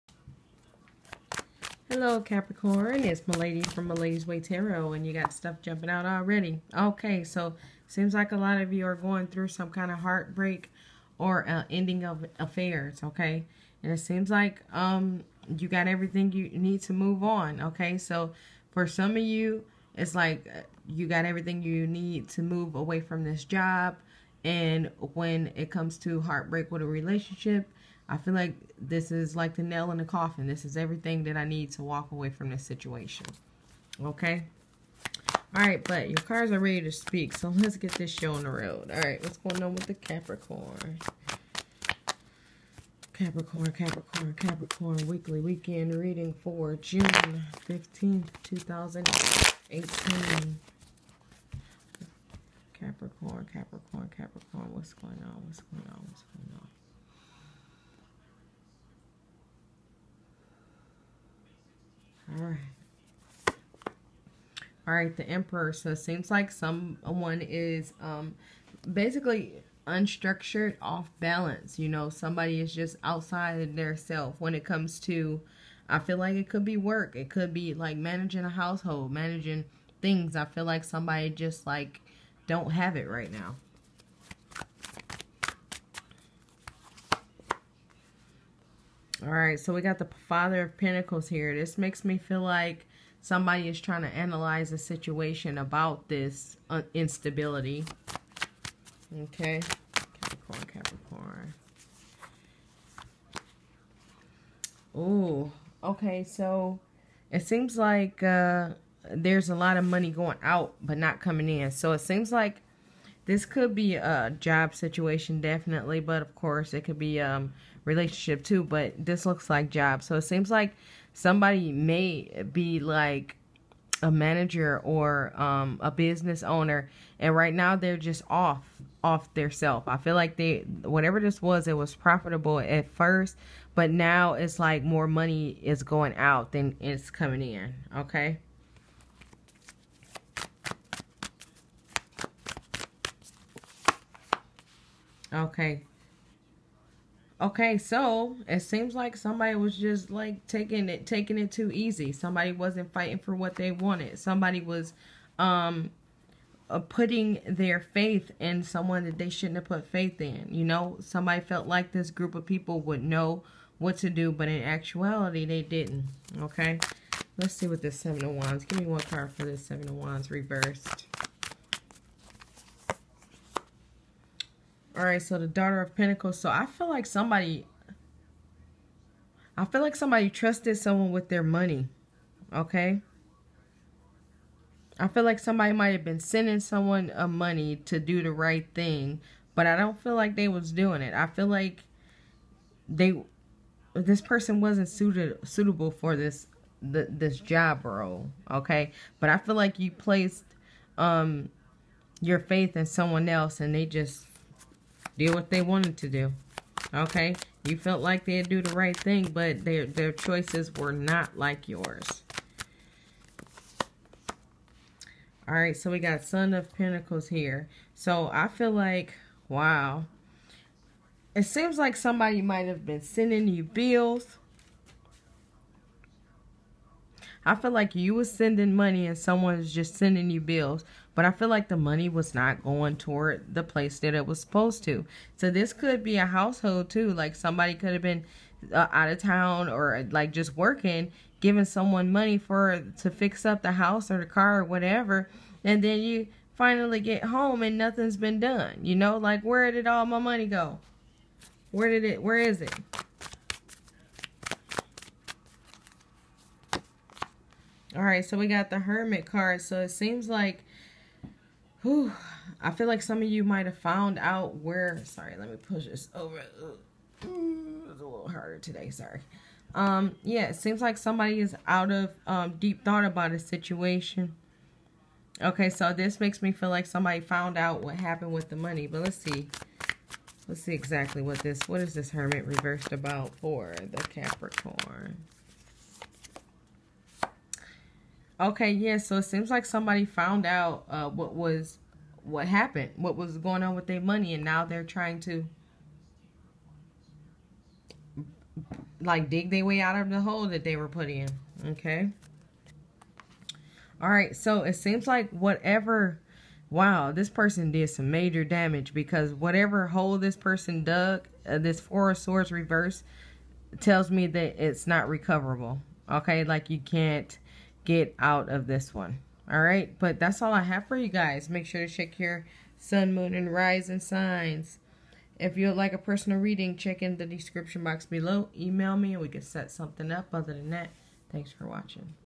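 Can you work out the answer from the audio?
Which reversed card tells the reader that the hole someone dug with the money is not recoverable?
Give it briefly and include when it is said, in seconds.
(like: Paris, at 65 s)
Four of Swords, at 311 s.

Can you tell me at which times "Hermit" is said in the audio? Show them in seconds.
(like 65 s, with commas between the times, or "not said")
258 s, 282 s.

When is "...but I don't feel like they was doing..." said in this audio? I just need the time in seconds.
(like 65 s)
189 s.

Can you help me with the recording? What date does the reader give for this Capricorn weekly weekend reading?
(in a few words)
June 15th, 2018.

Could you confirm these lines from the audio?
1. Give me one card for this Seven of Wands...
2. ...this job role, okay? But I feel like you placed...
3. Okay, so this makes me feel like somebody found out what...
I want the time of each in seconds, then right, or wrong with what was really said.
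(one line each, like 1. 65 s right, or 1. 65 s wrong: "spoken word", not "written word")
1. 168 s right
2. 197 s right
3. 275 s right.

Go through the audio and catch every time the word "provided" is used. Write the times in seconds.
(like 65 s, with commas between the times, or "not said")
not said.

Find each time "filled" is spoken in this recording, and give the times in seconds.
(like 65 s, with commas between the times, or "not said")
not said.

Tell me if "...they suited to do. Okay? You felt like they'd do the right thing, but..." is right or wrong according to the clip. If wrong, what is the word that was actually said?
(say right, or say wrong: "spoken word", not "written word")
wrong: "wanted", not "suited".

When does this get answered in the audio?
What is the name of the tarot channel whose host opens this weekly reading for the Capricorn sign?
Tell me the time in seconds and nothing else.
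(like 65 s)
3 s.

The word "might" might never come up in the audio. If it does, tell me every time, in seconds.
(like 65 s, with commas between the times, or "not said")
185 s, 222 s, 263 s.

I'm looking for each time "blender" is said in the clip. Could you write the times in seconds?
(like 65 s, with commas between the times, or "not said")
not said.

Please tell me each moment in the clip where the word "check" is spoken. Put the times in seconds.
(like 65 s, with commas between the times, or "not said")
321 s, 326 s.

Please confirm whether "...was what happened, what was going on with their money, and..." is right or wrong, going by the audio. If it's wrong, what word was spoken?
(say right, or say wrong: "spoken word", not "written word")
right.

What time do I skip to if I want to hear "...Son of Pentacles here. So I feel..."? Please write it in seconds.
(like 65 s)
216 s.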